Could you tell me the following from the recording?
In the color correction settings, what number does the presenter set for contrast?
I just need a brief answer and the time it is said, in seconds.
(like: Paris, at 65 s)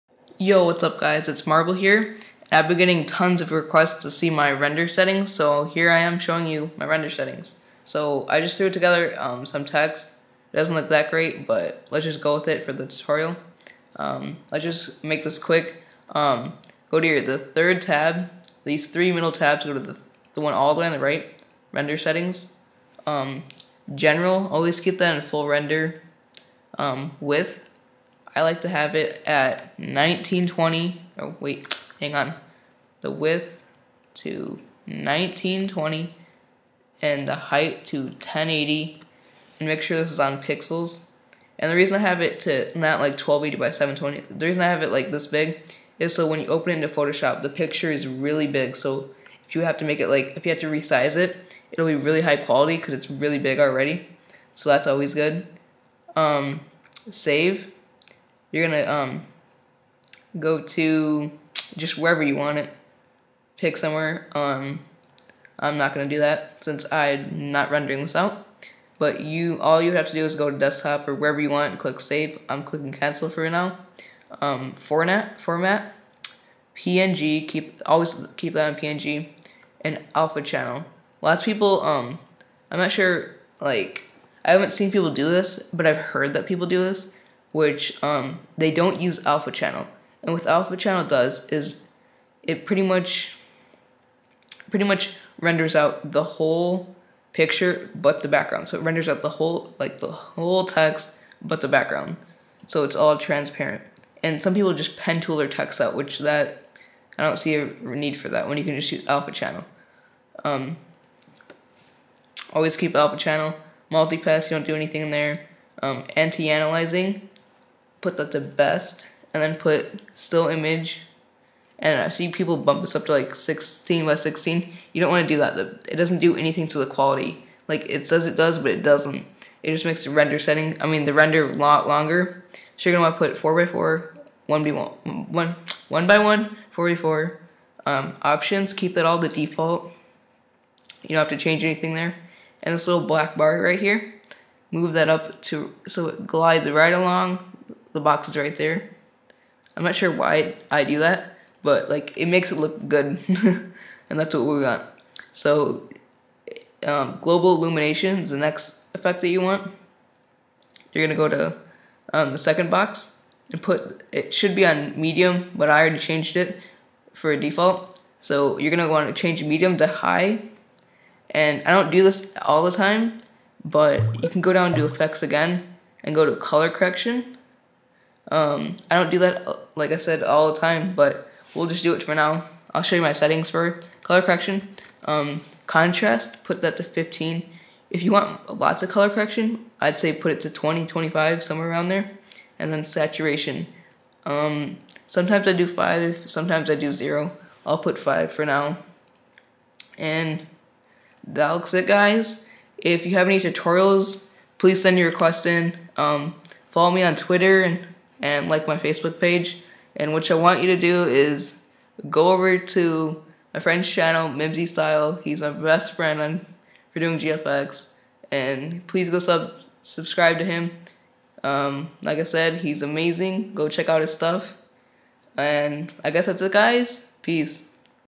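15, at 186 s.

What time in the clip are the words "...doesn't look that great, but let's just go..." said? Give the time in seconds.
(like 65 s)
10 s.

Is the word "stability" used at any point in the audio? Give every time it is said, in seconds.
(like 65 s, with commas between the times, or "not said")
not said.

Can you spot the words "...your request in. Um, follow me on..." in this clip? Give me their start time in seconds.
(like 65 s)
204 s.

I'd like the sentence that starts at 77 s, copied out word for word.
Keep always keep that on PNG and alpha channel.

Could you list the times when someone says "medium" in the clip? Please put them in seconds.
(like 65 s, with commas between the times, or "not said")
164 s, 169 s.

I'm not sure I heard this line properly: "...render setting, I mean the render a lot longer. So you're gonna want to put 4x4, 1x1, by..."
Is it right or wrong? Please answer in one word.
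right.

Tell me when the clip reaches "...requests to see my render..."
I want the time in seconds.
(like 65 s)
3 s.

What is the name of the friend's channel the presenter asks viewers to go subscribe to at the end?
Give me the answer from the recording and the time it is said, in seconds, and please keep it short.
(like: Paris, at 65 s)
MimzyStyle, at 214 s.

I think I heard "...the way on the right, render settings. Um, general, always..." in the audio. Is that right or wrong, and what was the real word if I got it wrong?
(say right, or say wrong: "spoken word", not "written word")
right.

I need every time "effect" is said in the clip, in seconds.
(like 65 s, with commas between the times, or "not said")
158 s, 174 s.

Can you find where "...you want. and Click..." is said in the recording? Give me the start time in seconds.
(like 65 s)
71 s.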